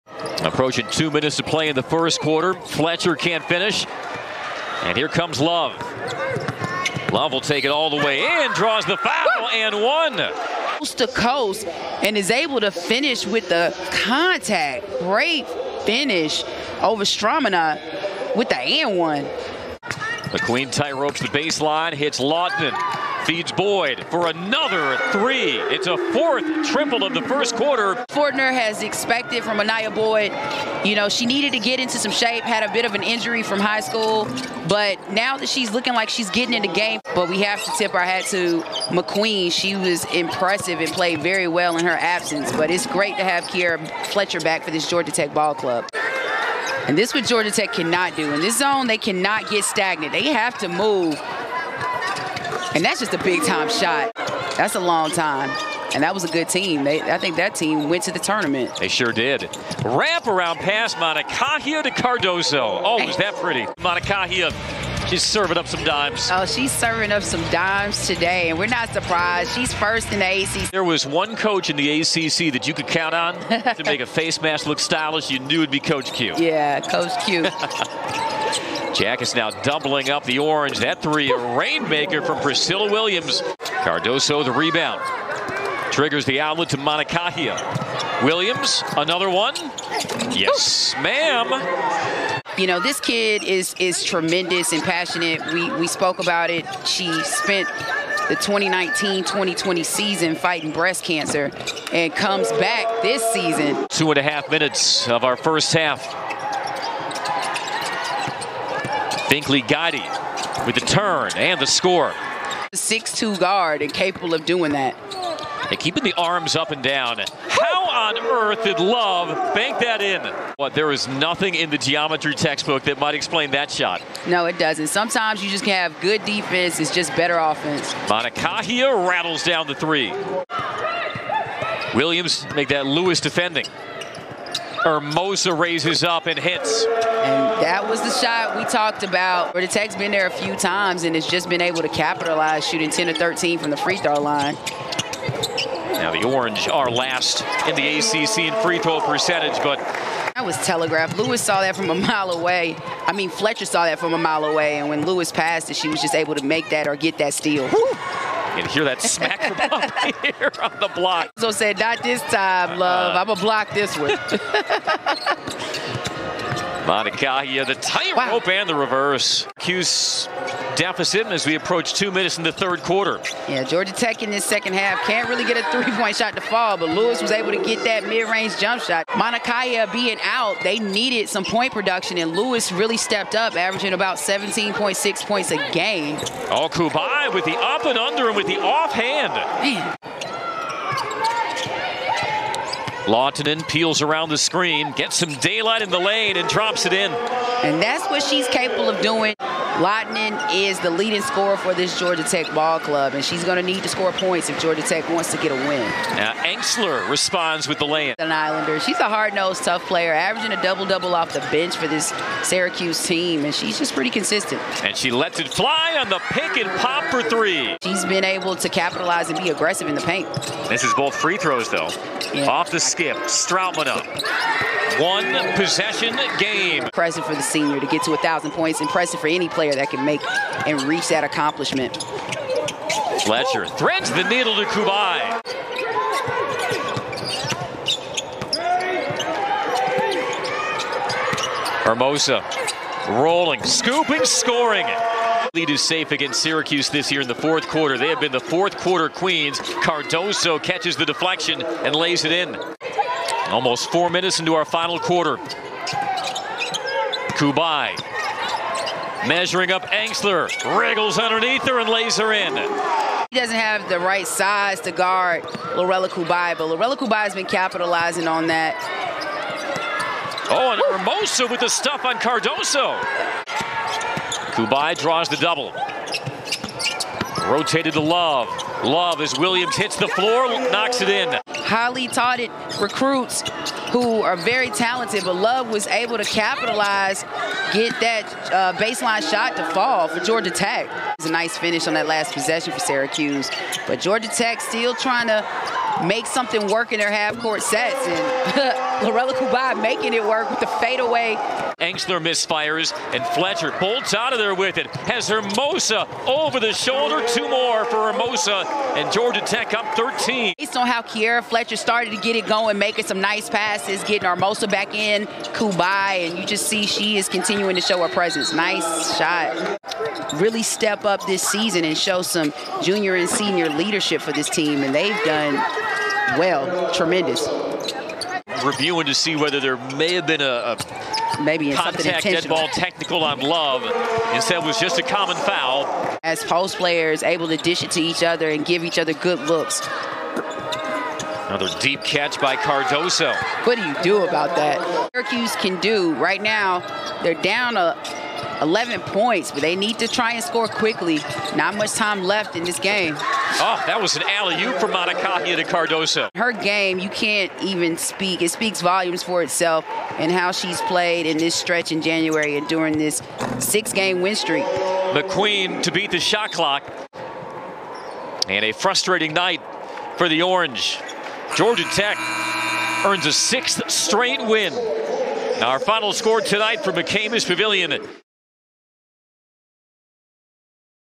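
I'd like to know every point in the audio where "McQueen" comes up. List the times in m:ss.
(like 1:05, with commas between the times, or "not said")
0:38, 6:04.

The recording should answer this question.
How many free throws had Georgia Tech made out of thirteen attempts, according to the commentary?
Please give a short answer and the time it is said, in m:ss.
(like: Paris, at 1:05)
10, at 2:22.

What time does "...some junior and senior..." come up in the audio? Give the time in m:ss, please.
5:22.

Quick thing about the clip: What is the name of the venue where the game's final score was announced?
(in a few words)
McCamish Pavilion.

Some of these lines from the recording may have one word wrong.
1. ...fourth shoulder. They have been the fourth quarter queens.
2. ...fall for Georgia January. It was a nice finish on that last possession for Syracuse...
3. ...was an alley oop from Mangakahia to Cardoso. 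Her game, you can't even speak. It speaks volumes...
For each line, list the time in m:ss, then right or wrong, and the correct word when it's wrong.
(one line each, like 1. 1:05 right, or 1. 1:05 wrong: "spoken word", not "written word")
1. 4:07 wrong: "quarter", not "shoulder"
2. 4:49 wrong: "Tech", not "January"
3. 5:54 right.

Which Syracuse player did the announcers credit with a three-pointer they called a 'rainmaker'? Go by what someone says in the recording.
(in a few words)
Priscilla Williams.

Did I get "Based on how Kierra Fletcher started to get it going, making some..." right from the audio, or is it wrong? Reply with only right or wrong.
right.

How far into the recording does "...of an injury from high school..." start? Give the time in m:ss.
0:32.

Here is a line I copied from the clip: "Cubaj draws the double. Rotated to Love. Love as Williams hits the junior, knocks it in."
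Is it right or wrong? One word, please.
wrong.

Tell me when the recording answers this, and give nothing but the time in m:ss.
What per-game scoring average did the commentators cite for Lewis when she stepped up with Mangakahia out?
3:04.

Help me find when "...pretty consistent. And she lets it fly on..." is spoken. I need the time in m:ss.
3:33.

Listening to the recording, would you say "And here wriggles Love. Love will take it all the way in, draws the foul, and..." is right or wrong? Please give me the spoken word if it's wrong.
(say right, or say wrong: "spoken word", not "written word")
wrong: "comes", not "wriggles".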